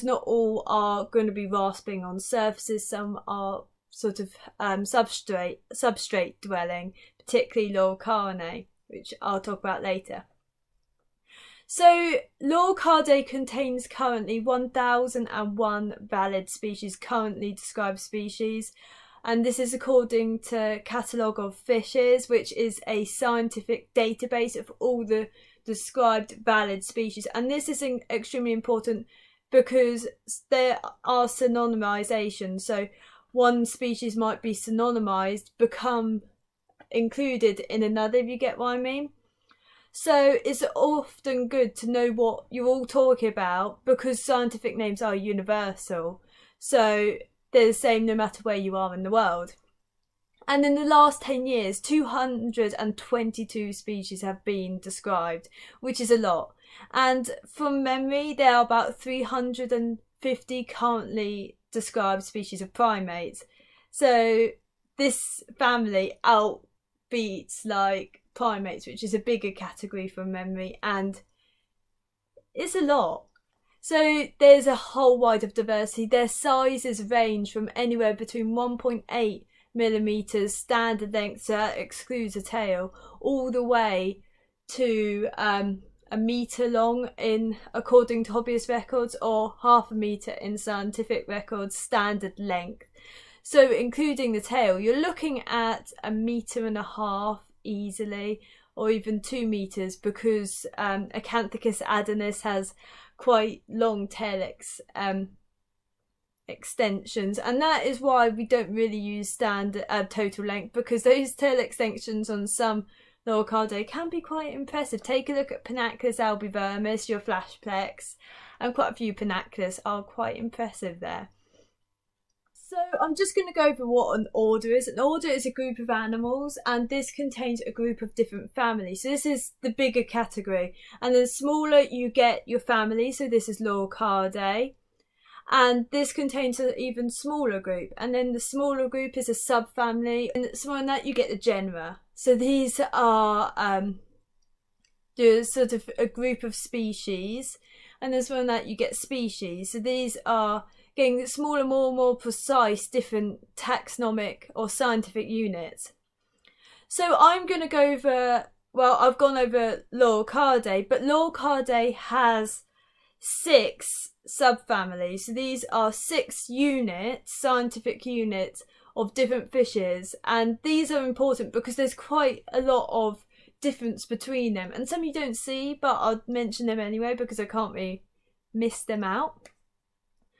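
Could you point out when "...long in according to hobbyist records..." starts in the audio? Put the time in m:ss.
1:26.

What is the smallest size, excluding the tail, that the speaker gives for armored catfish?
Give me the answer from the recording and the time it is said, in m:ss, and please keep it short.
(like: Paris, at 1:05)
1.8 millimeters, at 1:18.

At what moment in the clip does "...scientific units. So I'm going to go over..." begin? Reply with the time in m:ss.
2:34.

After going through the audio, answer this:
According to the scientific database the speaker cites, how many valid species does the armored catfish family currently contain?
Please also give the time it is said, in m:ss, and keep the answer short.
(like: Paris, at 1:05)
1,001, at 0:14.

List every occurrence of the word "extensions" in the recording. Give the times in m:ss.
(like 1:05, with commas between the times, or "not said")
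1:46, 1:51.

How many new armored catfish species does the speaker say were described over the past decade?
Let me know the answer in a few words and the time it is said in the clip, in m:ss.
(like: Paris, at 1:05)
222, at 0:51.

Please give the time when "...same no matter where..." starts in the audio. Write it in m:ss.
0:47.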